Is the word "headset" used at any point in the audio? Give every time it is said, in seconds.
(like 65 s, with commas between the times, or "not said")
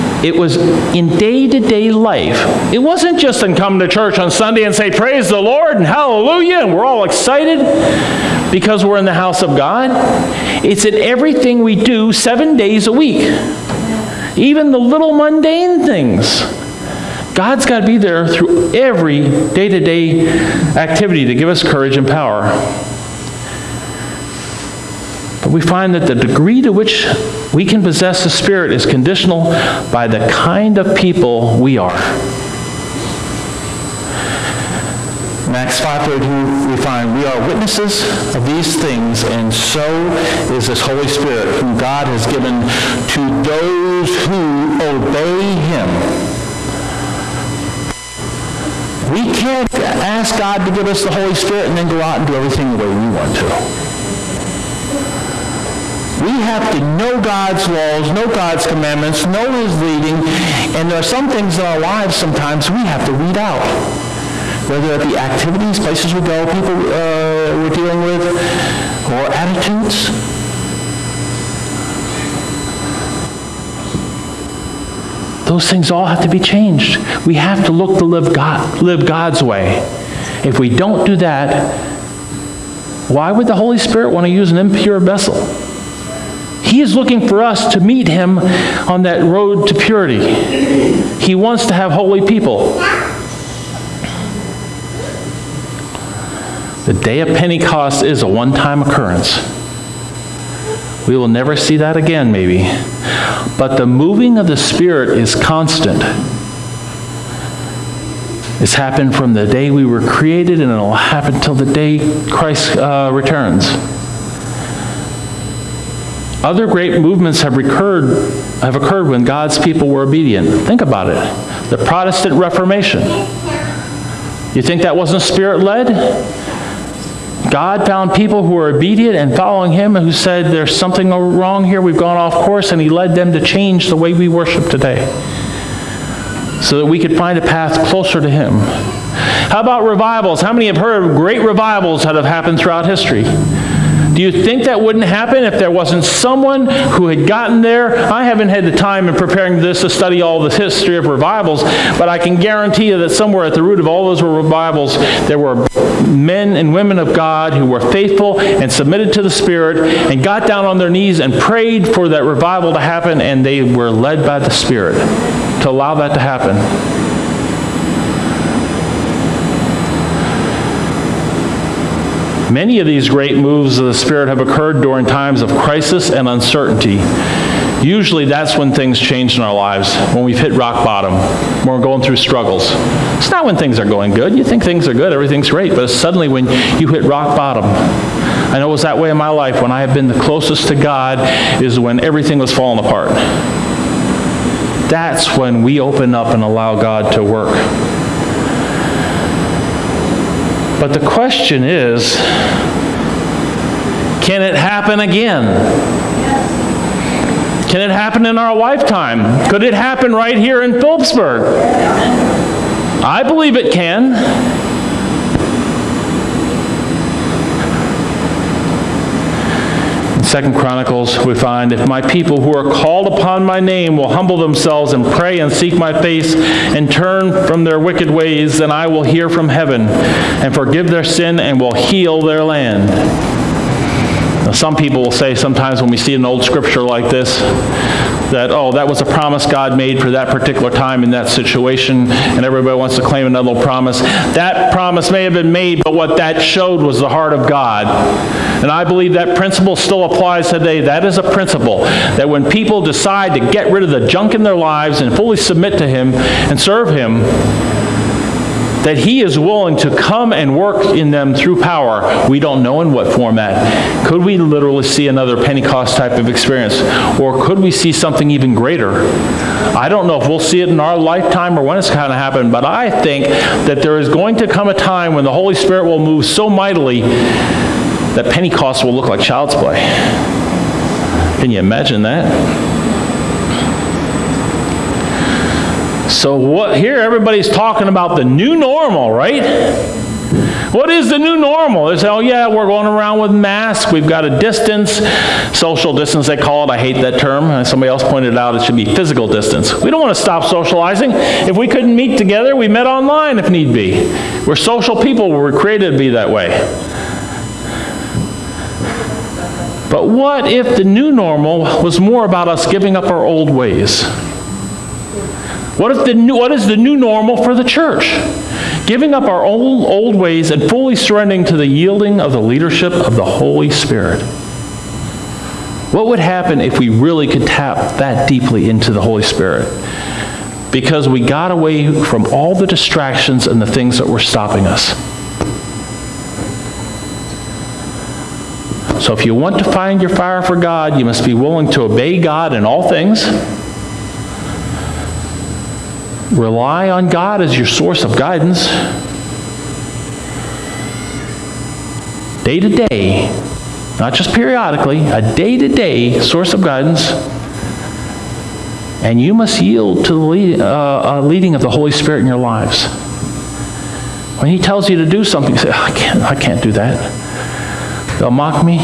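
not said.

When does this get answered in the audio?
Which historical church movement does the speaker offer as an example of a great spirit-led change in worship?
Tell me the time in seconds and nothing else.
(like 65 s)
121 s.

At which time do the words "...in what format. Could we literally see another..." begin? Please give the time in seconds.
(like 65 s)
262 s.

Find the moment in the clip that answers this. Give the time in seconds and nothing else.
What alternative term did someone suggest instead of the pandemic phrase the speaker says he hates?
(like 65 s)
298 s.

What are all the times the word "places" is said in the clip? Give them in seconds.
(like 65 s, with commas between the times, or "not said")
65 s.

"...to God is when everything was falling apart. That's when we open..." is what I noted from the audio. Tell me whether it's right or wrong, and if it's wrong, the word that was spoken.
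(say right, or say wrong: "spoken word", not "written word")
right.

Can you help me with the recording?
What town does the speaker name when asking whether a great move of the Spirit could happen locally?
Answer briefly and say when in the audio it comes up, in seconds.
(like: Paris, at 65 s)
Philipsburg, at 210 s.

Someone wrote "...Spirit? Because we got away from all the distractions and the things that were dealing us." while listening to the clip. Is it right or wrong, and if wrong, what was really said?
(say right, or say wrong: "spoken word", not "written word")
wrong: "stopping", not "dealing".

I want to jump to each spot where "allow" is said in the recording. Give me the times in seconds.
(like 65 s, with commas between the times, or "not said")
165 s, 196 s.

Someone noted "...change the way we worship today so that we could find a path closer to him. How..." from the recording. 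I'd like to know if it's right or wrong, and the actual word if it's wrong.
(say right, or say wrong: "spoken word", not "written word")
right.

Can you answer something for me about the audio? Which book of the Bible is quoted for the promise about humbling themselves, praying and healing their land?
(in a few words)
Second Chronicles.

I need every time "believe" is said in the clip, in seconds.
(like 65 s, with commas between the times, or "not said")
213 s, 248 s.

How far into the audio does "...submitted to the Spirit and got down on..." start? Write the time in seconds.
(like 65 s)
158 s.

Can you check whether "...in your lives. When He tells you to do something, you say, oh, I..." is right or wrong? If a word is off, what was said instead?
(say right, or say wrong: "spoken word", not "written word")
right.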